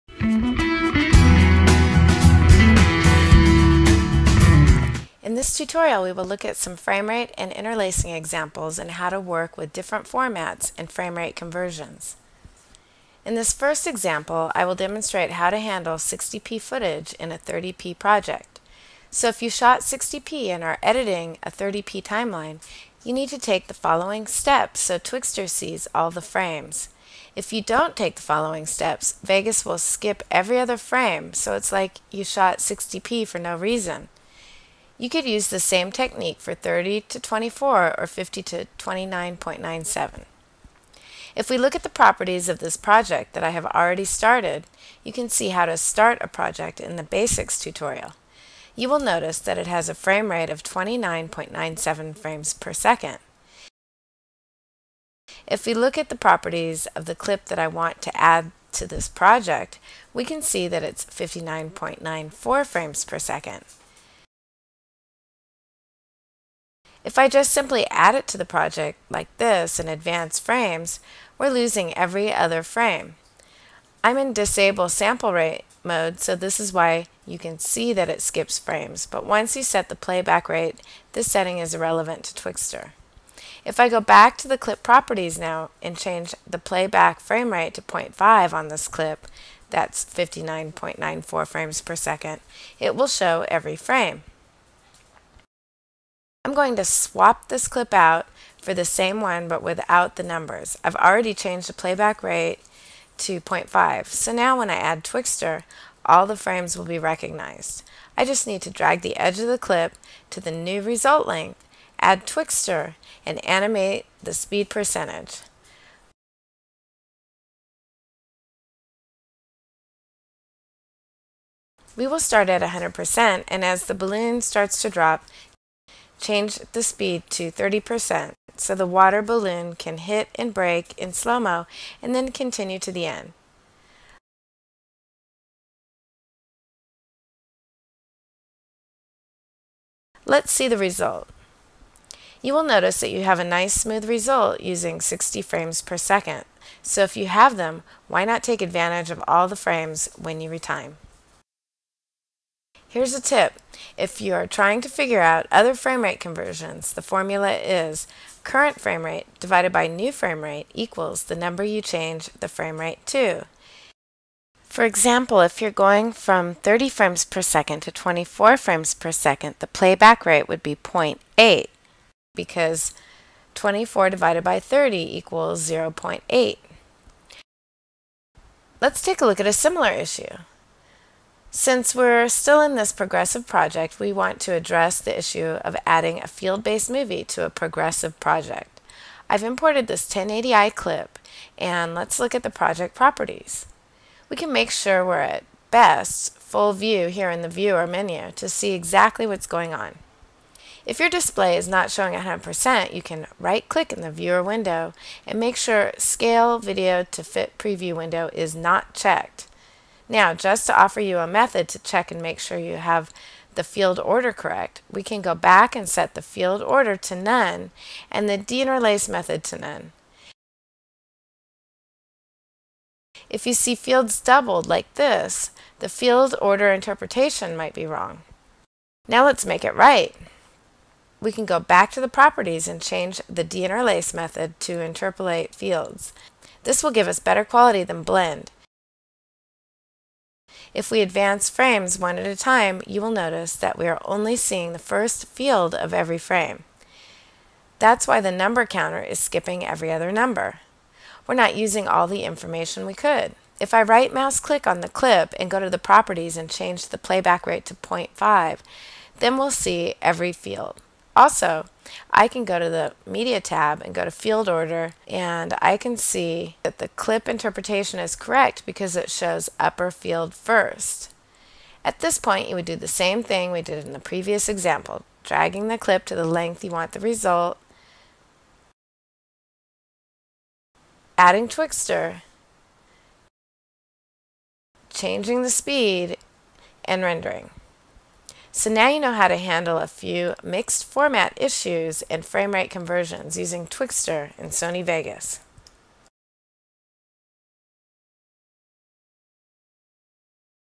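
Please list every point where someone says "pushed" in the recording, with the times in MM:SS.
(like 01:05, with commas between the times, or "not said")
not said.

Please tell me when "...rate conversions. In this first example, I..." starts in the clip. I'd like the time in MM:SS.
00:11.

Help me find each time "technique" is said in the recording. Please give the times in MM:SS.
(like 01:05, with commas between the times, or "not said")
00:35.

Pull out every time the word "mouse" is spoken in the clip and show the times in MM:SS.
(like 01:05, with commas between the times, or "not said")
04:14.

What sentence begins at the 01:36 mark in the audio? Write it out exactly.
I'm going to swap this clip out for the same one but without the numbers.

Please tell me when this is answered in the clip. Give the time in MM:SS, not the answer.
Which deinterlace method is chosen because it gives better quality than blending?
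03:54.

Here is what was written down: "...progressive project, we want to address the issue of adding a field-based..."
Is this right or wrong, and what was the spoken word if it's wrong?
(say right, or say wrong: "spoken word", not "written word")
right.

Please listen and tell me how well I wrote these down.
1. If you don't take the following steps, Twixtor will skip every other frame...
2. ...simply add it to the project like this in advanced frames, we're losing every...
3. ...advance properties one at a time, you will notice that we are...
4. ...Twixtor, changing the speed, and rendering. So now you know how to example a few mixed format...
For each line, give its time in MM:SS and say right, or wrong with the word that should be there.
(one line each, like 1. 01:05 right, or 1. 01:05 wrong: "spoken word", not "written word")
1. 00:27 wrong: "Vegas", not "Twixtor"
2. 01:07 right
3. 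04:01 wrong: "frames", not "properties"
4. 04:41 wrong: "handle", not "example".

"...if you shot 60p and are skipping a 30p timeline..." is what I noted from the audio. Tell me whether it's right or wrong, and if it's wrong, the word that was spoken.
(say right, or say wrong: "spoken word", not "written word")
wrong: "editing", not "skipping".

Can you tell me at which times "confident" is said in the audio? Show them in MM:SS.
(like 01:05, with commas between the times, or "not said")
not said.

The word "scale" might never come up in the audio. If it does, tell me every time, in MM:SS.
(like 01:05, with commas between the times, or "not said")
03:25.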